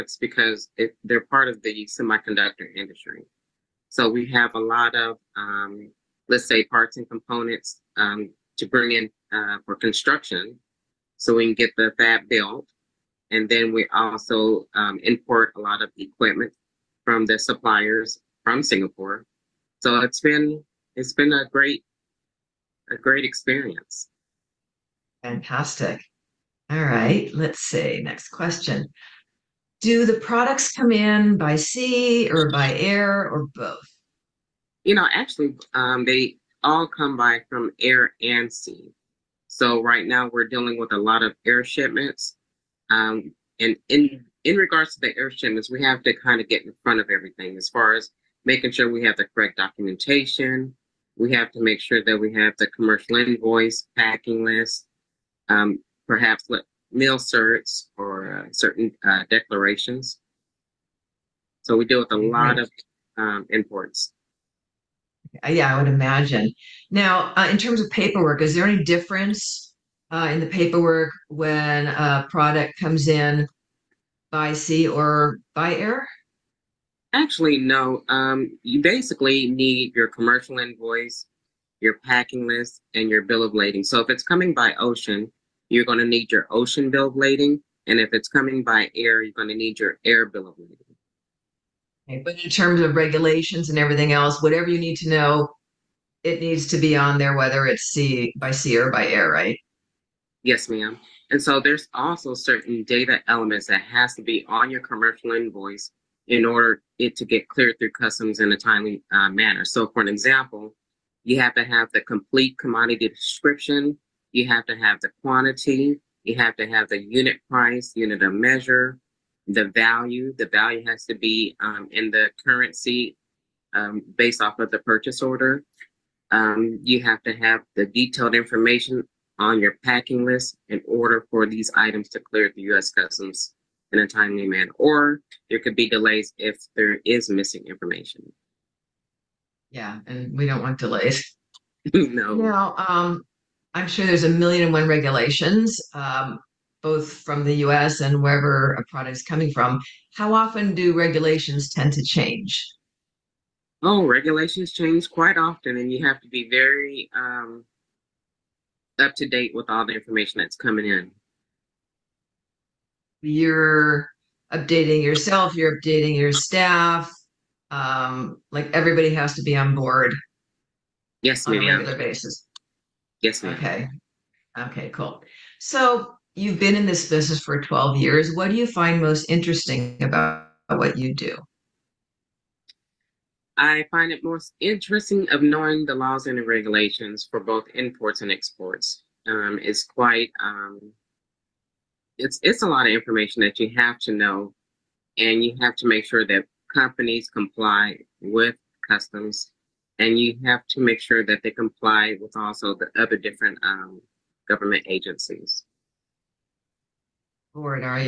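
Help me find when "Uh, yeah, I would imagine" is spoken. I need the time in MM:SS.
01:05.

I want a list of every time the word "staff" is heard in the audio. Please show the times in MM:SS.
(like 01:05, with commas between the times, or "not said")
02:46.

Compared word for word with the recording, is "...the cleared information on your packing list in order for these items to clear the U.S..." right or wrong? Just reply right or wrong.
wrong.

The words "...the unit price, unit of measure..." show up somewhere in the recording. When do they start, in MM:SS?
01:56.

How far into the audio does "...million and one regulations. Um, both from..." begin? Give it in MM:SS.
02:24.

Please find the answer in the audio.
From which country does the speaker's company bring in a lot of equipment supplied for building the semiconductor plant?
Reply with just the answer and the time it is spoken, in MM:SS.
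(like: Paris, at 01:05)
Singapore, at 00:18.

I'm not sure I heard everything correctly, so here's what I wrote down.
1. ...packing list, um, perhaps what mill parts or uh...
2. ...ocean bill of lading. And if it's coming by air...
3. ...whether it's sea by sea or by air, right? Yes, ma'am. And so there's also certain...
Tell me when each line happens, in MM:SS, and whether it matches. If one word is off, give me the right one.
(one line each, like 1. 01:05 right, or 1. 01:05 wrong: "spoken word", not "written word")
1. 00:53 wrong: "certs", not "parts"
2. 01:26 right
3. 01:37 right.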